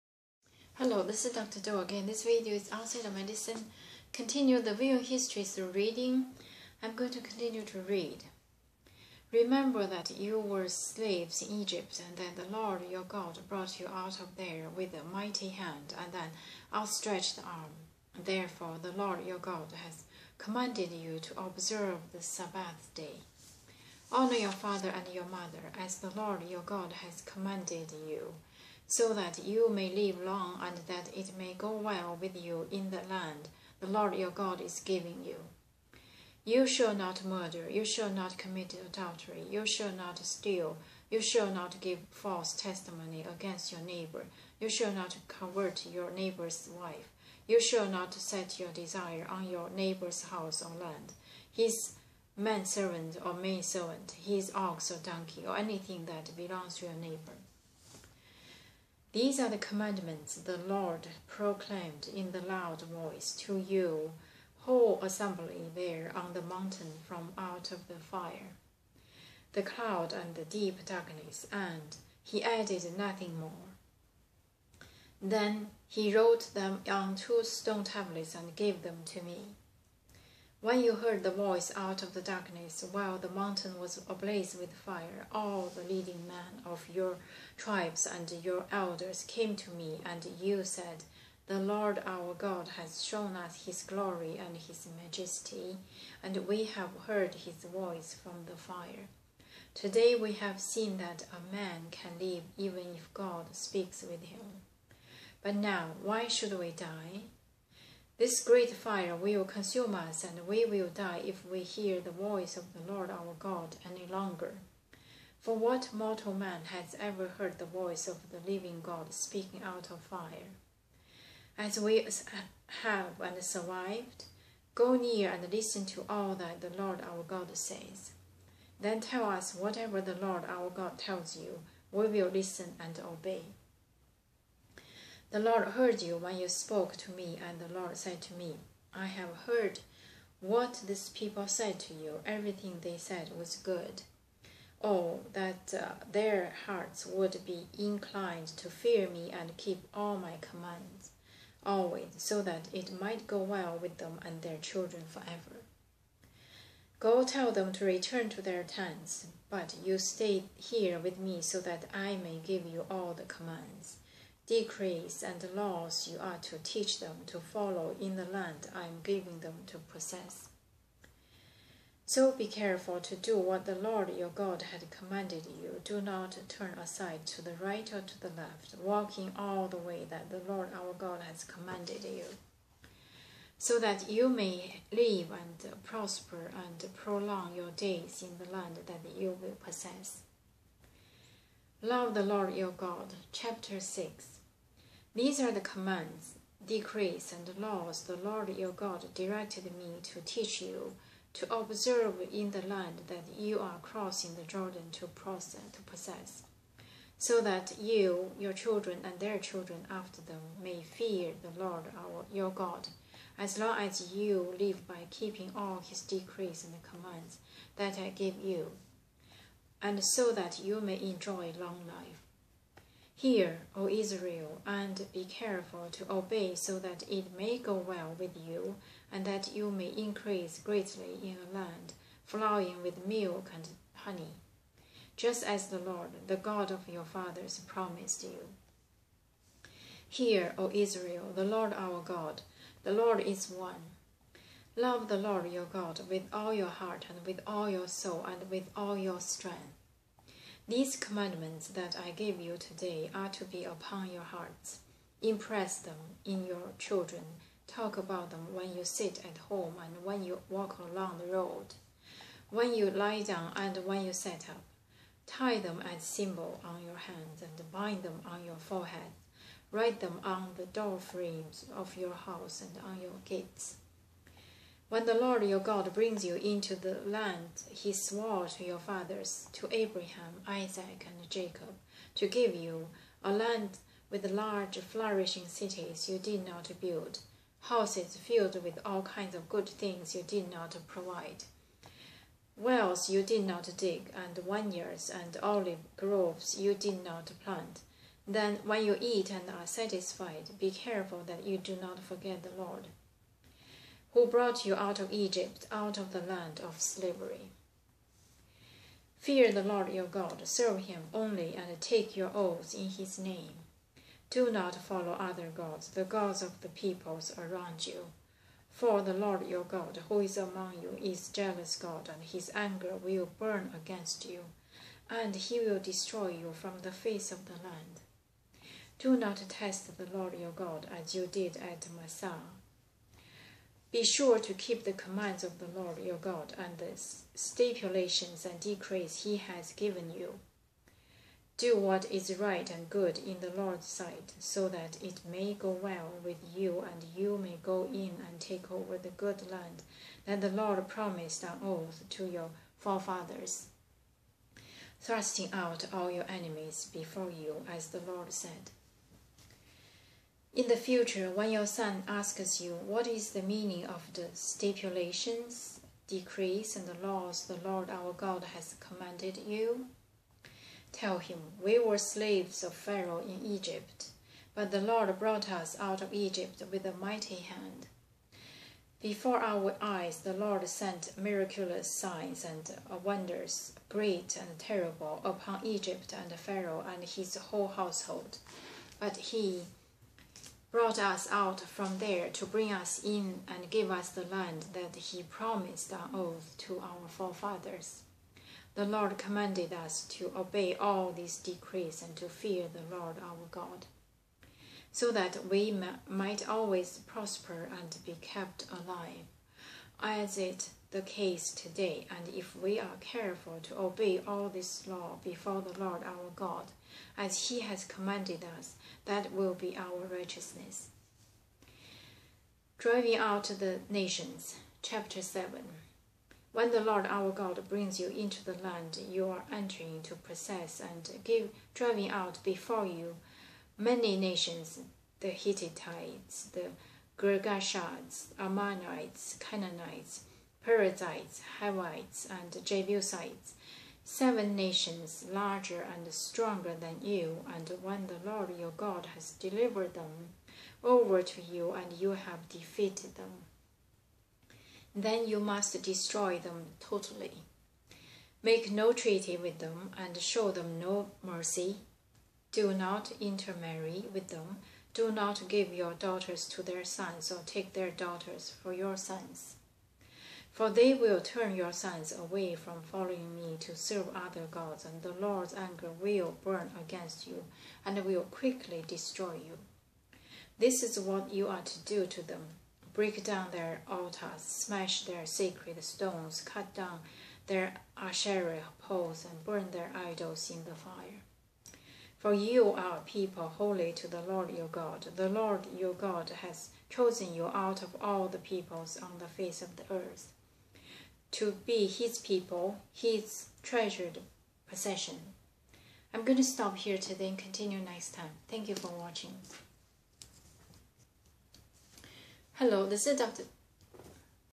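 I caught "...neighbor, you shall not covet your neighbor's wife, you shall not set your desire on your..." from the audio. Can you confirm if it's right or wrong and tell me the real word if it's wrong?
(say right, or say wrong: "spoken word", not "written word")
right.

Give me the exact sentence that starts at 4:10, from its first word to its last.
These commandments that I give you today are to be upon your hearts.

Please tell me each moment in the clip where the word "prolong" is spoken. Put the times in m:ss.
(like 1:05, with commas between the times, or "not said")
3:06.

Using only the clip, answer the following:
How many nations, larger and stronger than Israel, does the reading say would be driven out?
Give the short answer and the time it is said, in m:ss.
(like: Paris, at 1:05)
7, at 7:24.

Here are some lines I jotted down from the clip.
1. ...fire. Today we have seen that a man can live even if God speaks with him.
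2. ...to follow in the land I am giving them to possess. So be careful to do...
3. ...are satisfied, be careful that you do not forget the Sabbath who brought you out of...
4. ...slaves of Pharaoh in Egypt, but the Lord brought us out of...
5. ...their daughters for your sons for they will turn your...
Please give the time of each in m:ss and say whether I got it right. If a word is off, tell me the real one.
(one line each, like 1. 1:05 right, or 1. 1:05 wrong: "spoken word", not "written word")
1. 1:38 right
2. 2:47 right
3. 4:59 wrong: "Lord", not "Sabbath"
4. 6:11 right
5. 7:47 right.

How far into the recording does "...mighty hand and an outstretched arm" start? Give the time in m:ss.
0:15.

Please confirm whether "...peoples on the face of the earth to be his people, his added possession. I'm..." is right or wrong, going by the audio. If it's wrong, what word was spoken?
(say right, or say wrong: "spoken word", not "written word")
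wrong: "treasured", not "added".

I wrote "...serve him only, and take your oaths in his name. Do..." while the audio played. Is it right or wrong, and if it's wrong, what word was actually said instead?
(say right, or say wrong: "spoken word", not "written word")
right.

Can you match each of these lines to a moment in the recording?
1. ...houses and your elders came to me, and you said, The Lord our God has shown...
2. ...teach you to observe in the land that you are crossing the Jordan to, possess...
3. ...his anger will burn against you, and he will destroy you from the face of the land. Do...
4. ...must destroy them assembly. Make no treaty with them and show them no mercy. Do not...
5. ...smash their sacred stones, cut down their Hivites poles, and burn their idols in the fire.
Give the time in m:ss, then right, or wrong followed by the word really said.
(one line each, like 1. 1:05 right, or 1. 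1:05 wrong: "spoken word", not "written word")
1. 1:27 wrong: "tribes", not "houses"
2. 3:20 right
3. 5:22 right
4. 7:35 wrong: "totally", not "assembly"
5. 8:04 wrong: "Asherah", not "Hivites".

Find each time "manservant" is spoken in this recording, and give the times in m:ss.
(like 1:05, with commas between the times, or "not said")
0:52.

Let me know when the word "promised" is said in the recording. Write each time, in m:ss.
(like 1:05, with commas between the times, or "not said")
3:57, 5:50, 6:35.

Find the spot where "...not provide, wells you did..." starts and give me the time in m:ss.
4:50.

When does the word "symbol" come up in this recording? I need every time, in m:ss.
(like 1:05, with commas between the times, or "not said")
4:26.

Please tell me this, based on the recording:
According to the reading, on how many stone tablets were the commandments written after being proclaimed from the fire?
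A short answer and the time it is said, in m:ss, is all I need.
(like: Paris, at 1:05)
2, at 1:17.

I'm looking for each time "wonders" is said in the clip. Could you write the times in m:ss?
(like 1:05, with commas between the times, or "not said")
6:23.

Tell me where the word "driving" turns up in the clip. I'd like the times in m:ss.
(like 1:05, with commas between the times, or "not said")
7:02, 7:11.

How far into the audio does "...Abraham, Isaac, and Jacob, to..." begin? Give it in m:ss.
4:39.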